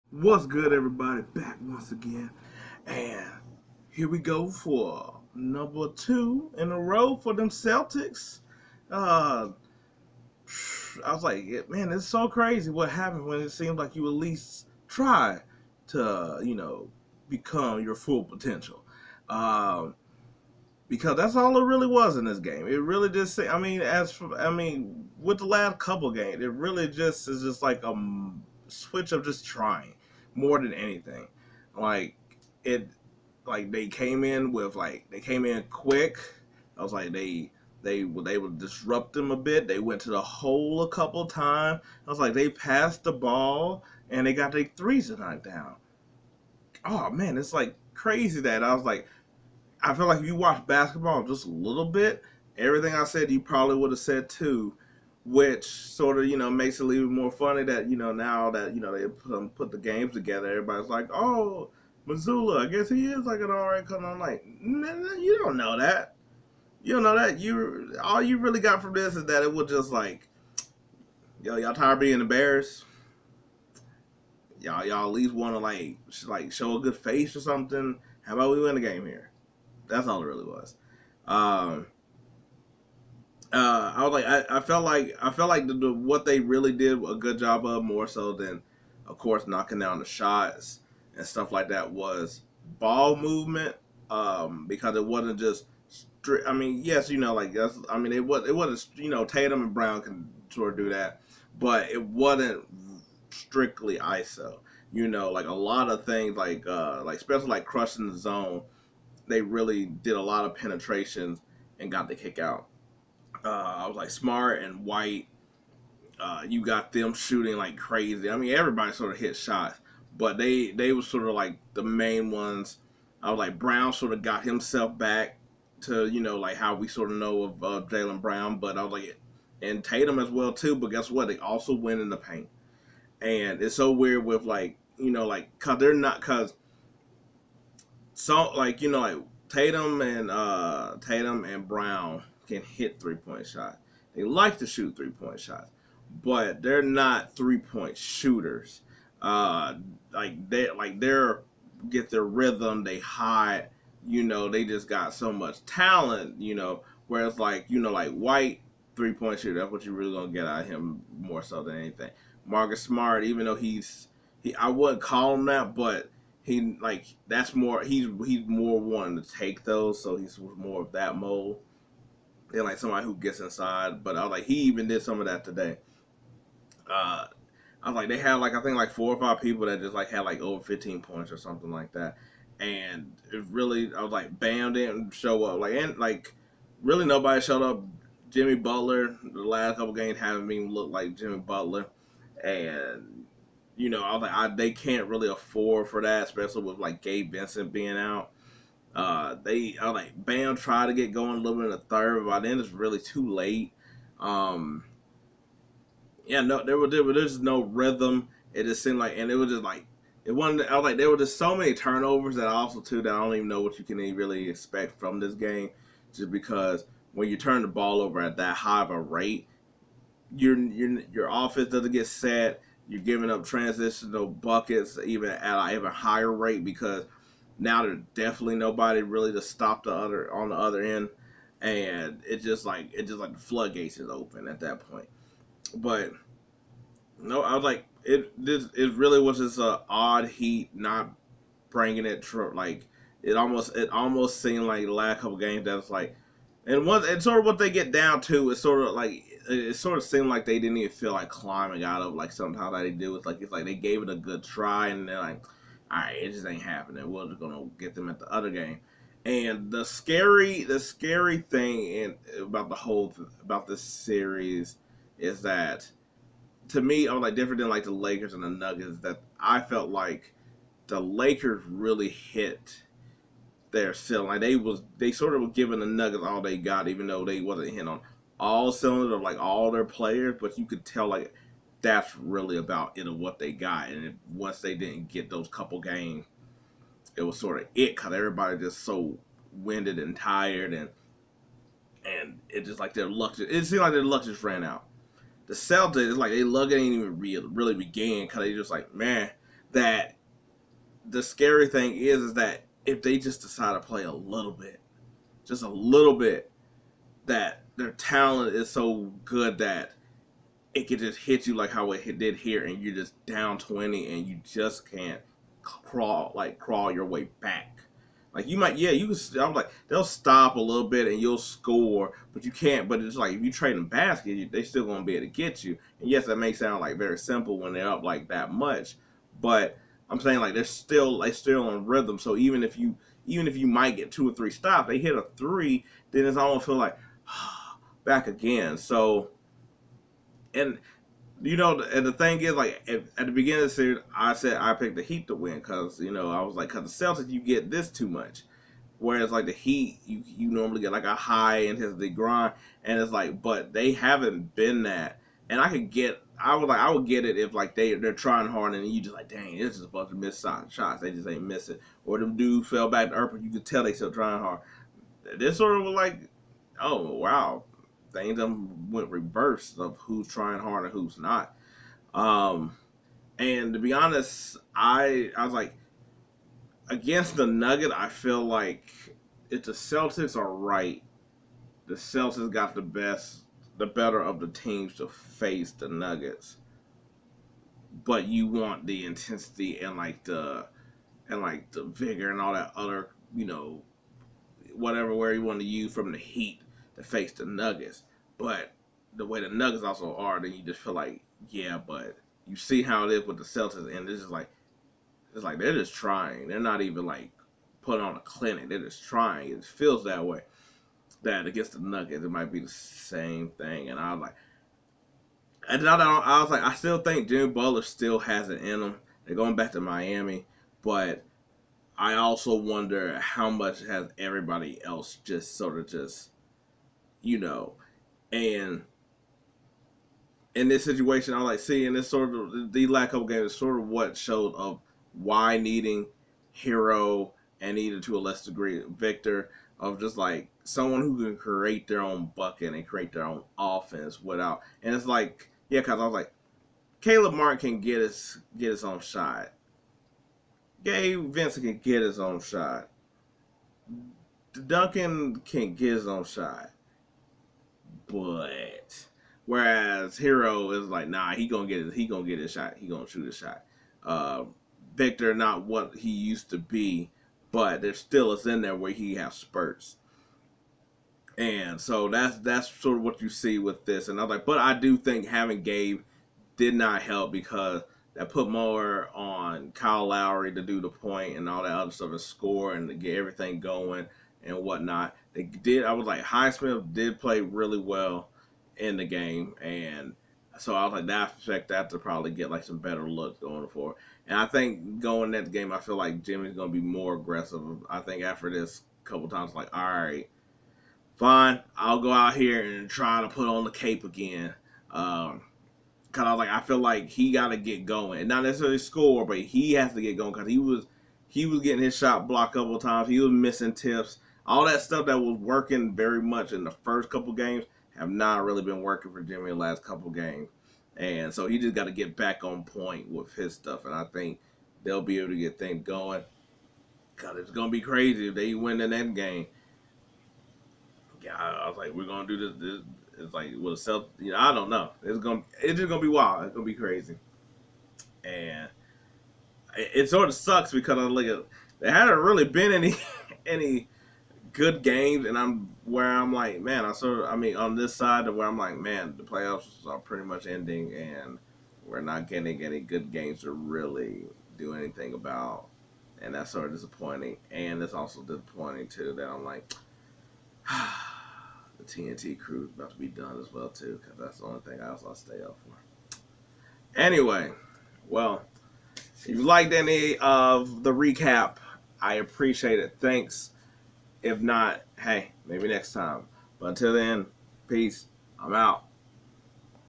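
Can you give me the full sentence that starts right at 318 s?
Like you might, yeah, you can.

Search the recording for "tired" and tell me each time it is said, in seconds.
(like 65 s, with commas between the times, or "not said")
71 s, 290 s.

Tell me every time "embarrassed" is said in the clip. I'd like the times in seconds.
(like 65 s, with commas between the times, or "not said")
72 s.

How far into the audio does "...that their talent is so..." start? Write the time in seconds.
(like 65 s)
307 s.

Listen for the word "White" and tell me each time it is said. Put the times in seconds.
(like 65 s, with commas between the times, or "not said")
114 s, 158 s.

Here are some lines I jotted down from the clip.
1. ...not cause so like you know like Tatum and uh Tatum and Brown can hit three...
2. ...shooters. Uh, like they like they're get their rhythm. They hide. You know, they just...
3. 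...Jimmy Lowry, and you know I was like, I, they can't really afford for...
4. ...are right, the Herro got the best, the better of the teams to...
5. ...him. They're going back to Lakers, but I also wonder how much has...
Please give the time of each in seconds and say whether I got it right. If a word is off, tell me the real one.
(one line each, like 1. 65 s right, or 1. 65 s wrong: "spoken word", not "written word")
1. 135 s right
2. 147 s right
3. 191 s wrong: "Butler", not "Lowry"
4. 380 s wrong: "Celtics", not "Herro"
5. 418 s wrong: "Miami", not "Lakers".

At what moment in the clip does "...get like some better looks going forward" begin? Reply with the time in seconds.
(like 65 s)
492 s.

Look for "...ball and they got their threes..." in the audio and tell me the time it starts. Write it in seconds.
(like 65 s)
43 s.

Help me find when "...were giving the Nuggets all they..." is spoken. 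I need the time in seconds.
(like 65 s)
275 s.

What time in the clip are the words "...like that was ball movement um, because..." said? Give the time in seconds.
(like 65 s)
91 s.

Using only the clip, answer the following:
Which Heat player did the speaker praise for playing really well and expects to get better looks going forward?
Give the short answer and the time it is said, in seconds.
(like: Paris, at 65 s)
Highsmith, at 486 s.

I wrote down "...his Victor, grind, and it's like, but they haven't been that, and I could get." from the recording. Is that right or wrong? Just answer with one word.
wrong.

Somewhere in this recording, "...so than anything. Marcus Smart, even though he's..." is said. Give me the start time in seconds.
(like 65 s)
161 s.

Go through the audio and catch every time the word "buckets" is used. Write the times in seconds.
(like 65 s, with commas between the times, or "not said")
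224 s, 442 s.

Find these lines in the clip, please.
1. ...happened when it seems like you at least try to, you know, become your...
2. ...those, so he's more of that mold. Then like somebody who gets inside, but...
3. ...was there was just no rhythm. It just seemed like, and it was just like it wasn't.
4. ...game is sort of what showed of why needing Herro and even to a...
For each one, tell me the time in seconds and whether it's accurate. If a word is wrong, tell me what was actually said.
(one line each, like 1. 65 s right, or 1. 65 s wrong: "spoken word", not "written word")
1. 12 s right
2. 169 s right
3. 206 s right
4. 433 s right.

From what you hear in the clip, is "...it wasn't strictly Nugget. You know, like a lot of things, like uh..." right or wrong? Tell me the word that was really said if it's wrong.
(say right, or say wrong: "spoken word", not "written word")
wrong: "ISO", not "Nugget".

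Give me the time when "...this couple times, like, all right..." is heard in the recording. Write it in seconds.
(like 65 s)
498 s.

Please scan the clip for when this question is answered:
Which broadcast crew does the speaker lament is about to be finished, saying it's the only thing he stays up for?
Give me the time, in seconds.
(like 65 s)
561 s.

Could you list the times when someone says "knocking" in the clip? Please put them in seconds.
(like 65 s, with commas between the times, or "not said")
89 s.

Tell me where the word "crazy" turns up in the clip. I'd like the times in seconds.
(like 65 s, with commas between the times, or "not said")
12 s, 47 s, 117 s, 527 s, 536 s.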